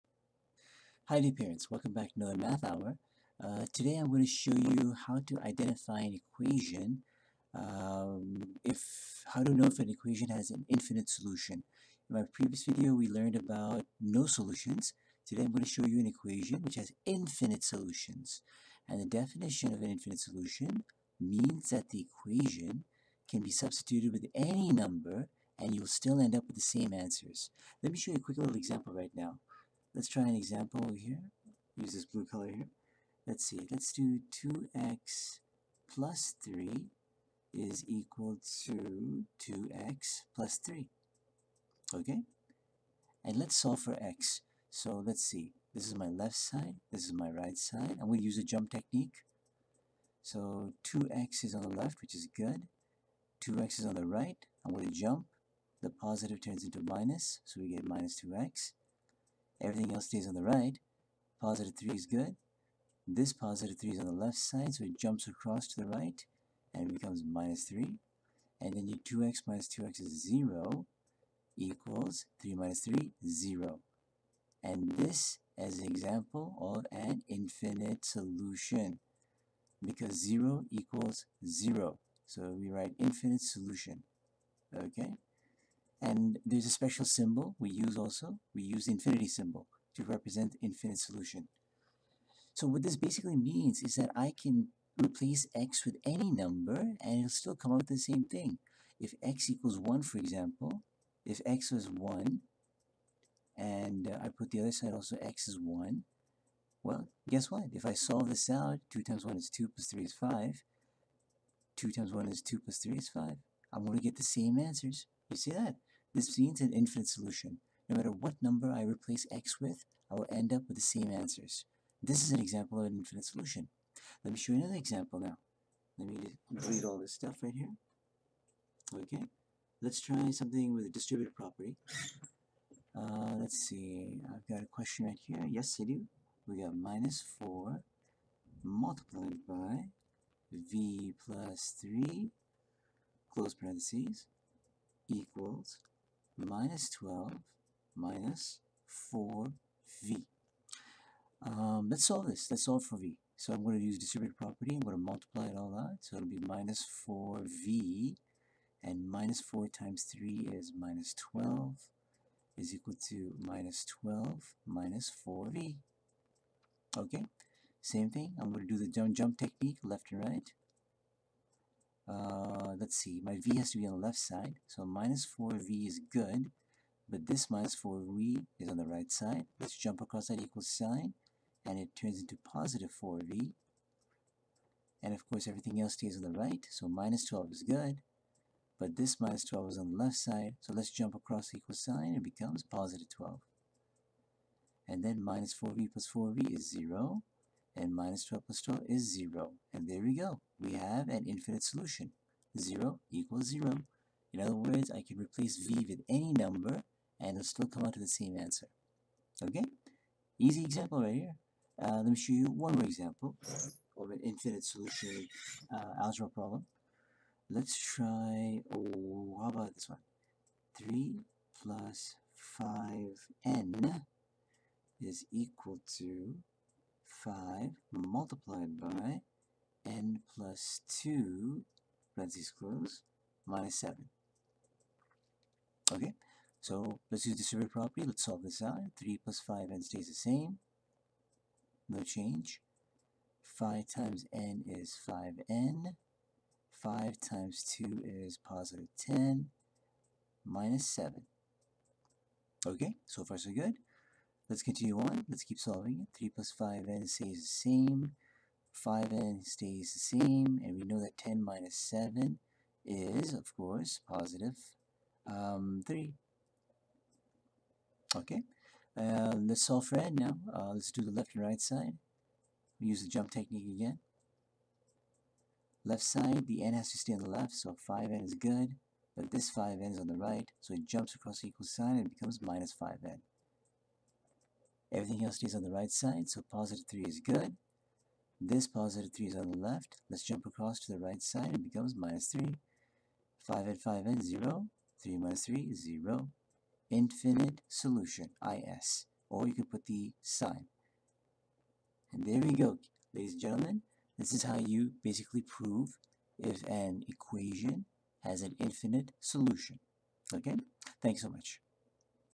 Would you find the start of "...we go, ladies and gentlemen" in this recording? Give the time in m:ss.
5:02.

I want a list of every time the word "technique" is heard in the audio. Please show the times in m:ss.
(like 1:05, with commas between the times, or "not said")
0:48, 2:49, 4:33.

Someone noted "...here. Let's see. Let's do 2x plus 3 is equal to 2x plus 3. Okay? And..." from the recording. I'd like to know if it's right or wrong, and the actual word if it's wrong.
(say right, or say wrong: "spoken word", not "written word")
right.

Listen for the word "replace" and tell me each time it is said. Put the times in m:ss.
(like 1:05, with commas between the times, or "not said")
1:35, 1:58, 3:25.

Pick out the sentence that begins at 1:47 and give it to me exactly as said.
If I solve this out, 2 times 1 is 2 plus 3 is 5.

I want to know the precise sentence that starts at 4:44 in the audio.
Everything else is on the right side, so positive 3 is good.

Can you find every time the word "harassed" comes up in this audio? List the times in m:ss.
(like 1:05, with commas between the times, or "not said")
not said.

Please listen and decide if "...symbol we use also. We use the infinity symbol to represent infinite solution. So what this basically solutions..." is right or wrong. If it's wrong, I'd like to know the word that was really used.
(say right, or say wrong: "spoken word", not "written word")
wrong: "means", not "solutions".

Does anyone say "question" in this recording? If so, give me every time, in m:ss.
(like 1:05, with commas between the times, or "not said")
2:14.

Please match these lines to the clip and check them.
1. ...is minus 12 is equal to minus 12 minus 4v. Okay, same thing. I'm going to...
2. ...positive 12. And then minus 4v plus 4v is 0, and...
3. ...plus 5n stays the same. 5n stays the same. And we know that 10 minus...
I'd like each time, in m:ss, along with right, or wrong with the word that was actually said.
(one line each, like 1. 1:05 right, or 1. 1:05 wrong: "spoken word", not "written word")
1. 2:40 right
2. 3:12 right
3. 4:16 right.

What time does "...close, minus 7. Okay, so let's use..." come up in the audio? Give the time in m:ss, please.
3:52.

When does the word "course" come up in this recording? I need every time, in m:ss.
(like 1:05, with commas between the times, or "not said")
3:05, 4:23.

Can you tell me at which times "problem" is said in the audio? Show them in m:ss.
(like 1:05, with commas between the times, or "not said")
3:36.